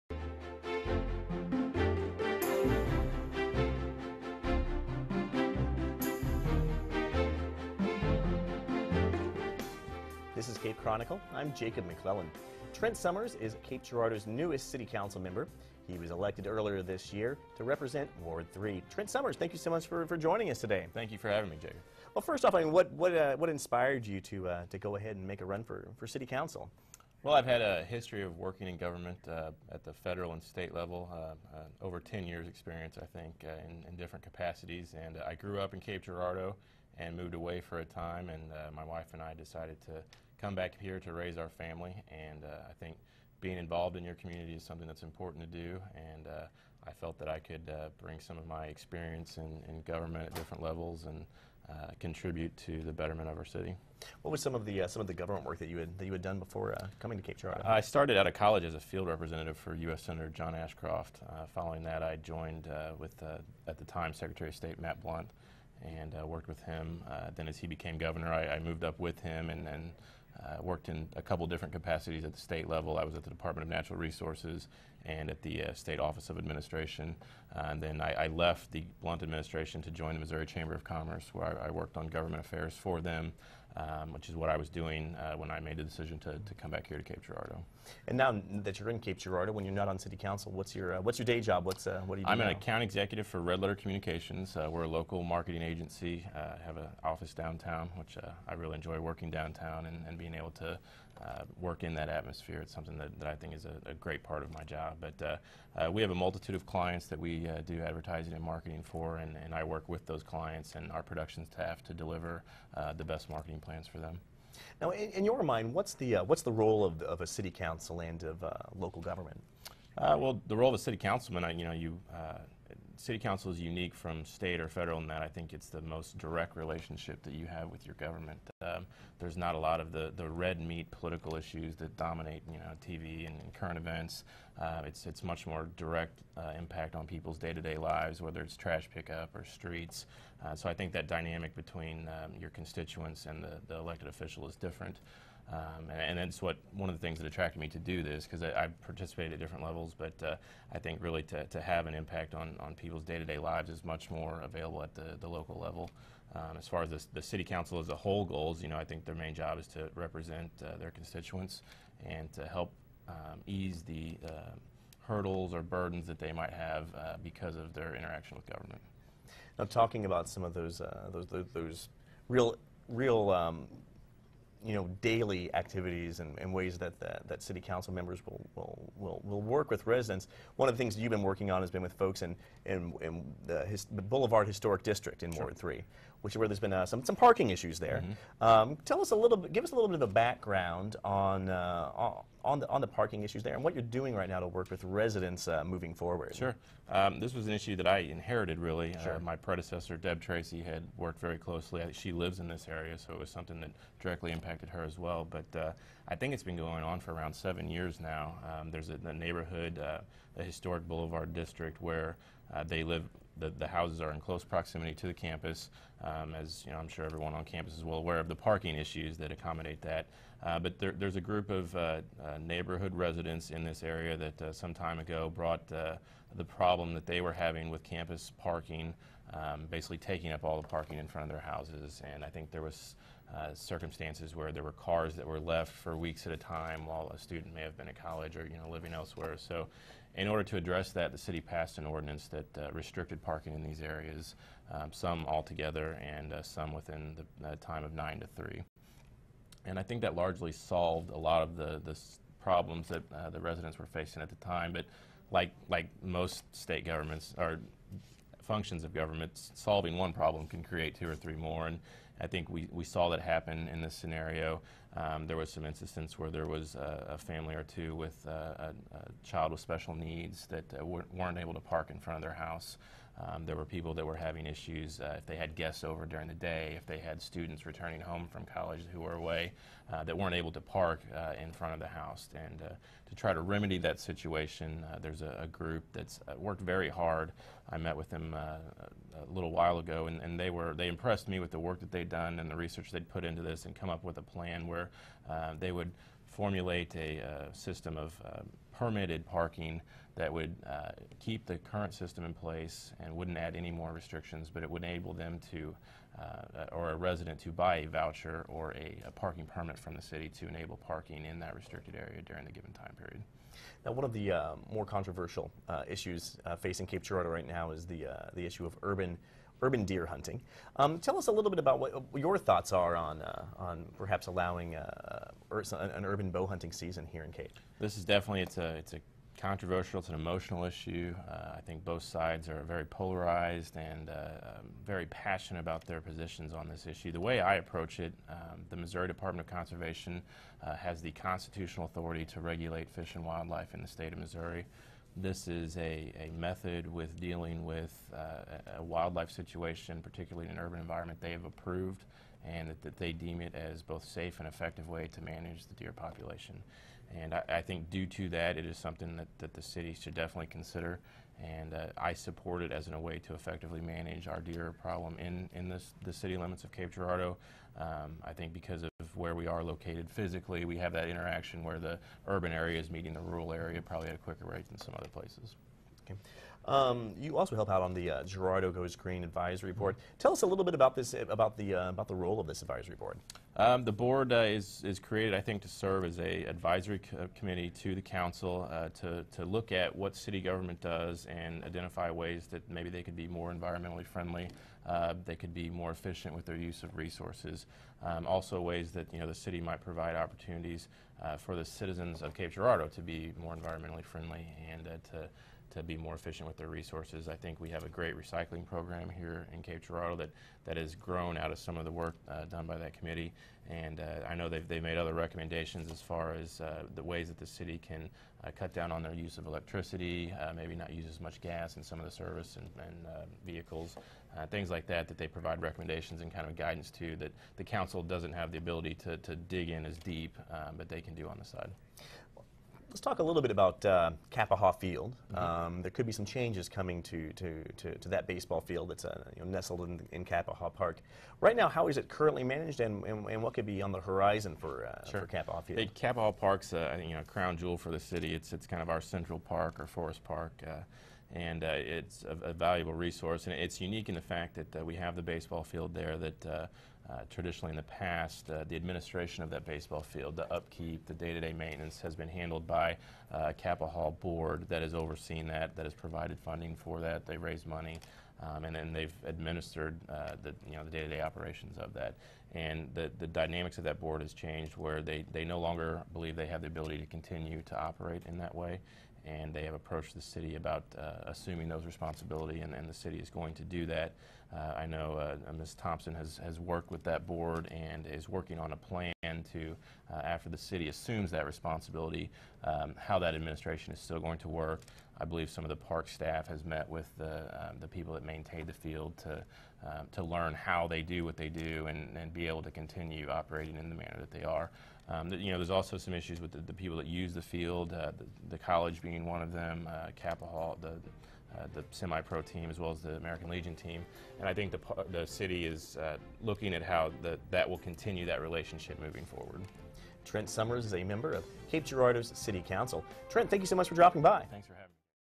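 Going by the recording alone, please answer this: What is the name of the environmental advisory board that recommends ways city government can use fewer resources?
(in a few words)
Girardeau Goes Green.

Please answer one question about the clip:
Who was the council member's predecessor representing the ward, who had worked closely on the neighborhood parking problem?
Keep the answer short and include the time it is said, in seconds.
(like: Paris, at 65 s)
Deb Tracy, at 199 s.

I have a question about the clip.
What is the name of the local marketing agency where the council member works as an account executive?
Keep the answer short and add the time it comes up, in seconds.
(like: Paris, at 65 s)
Red Letter Communications, at 93 s.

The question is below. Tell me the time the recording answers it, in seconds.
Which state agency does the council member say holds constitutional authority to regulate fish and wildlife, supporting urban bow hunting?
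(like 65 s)
338 s.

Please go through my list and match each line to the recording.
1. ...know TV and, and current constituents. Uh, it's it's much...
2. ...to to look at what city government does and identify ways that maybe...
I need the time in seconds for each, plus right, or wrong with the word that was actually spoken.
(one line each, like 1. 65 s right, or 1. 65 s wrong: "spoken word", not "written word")
1. 132 s wrong: "events", not "constituents"
2. 389 s right.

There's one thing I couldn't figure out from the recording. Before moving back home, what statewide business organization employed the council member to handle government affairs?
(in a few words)
Missouri Chamber of Commerce.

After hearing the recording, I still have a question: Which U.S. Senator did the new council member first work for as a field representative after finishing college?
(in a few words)
John Ashcroft.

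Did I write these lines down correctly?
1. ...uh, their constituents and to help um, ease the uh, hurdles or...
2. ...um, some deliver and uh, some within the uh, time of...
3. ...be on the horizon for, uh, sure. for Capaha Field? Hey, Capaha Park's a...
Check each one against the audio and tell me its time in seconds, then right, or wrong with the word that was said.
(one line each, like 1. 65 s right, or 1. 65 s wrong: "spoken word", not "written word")
1. 160 s right
2. 244 s wrong: "altogether", not "deliver"
3. 443 s right.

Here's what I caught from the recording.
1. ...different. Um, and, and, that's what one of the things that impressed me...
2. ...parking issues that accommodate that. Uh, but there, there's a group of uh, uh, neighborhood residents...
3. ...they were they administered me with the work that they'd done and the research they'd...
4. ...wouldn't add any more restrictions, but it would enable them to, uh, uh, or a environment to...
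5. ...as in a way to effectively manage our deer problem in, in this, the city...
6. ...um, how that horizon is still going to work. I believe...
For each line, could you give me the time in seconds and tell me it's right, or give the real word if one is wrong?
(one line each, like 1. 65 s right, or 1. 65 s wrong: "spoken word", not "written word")
1. 144 s wrong: "attracted", not "impressed"
2. 218 s right
3. 290 s wrong: "impressed", not "administered"
4. 303 s wrong: "resident", not "environment"
5. 362 s right
6. 492 s wrong: "administration", not "horizon".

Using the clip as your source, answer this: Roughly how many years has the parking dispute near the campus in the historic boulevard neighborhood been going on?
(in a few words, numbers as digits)
seven years.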